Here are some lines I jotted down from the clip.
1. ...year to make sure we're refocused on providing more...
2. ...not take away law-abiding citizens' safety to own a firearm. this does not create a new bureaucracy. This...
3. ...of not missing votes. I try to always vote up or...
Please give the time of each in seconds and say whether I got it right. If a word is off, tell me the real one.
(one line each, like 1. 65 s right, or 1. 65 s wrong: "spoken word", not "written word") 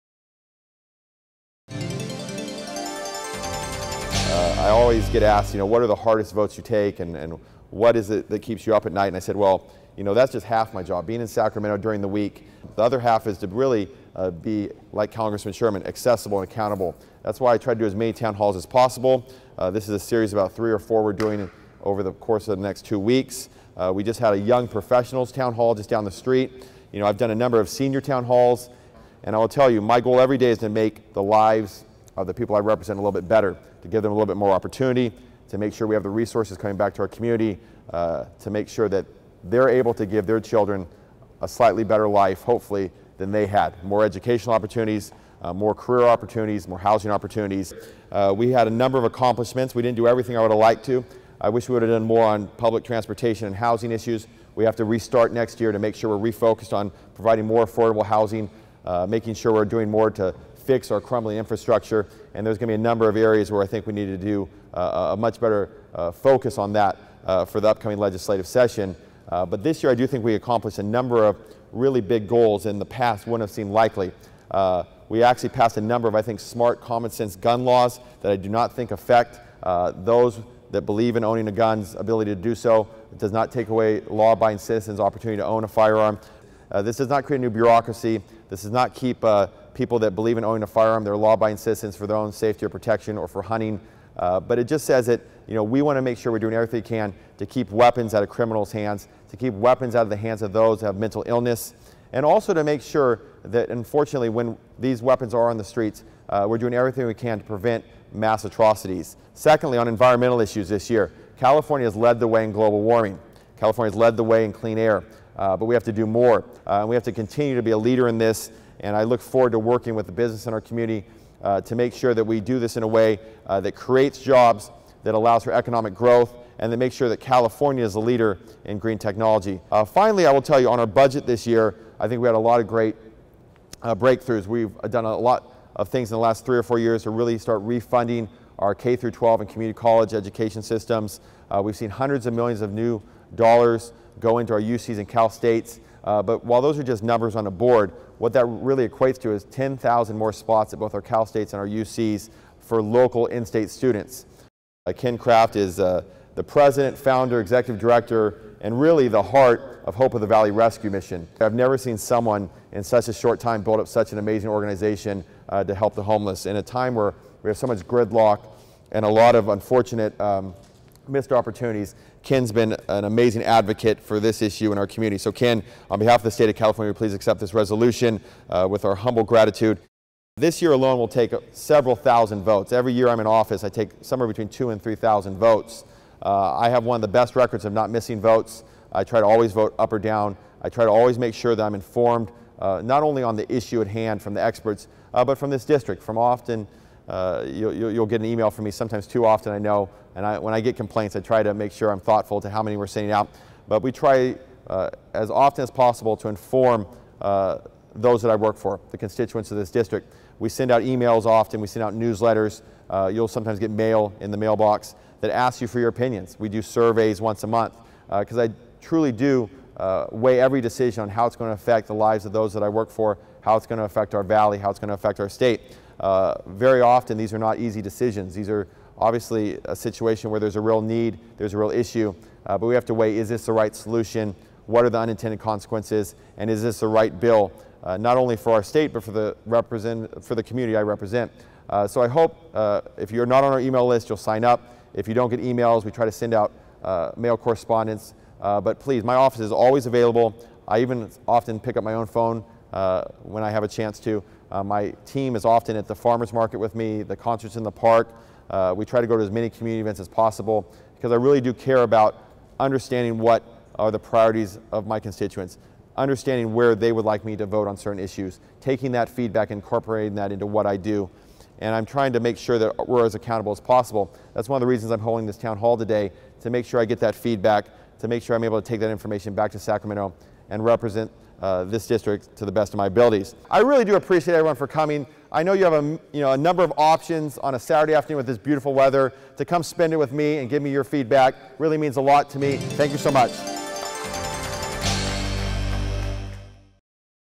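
1. 55 s right
2. 83 s wrong: "opportunity", not "safety"
3. 187 s right.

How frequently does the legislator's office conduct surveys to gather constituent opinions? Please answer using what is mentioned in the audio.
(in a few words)
Once a month.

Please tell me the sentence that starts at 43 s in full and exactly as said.
More educational opportunities, uh, more career opportunities, more housing opportunities.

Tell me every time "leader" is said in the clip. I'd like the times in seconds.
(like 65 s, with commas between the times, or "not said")
117 s, 127 s.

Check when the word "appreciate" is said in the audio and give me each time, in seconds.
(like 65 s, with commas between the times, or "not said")
283 s.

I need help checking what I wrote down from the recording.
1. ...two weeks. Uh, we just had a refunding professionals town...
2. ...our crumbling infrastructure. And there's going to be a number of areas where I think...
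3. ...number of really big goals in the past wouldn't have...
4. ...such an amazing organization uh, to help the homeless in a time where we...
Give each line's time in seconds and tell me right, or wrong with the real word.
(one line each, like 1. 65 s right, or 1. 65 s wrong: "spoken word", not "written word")
1. 22 s wrong: "young", not "refunding"
2. 60 s right
3. 70 s right
4. 163 s right.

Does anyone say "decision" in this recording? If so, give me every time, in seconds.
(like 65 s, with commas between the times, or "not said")
220 s, 227 s.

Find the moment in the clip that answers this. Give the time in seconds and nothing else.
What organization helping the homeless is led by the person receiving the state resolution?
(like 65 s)
159 s.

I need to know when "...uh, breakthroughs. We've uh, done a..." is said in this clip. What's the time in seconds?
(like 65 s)
133 s.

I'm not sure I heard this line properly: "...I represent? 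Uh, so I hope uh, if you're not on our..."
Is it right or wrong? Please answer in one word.
right.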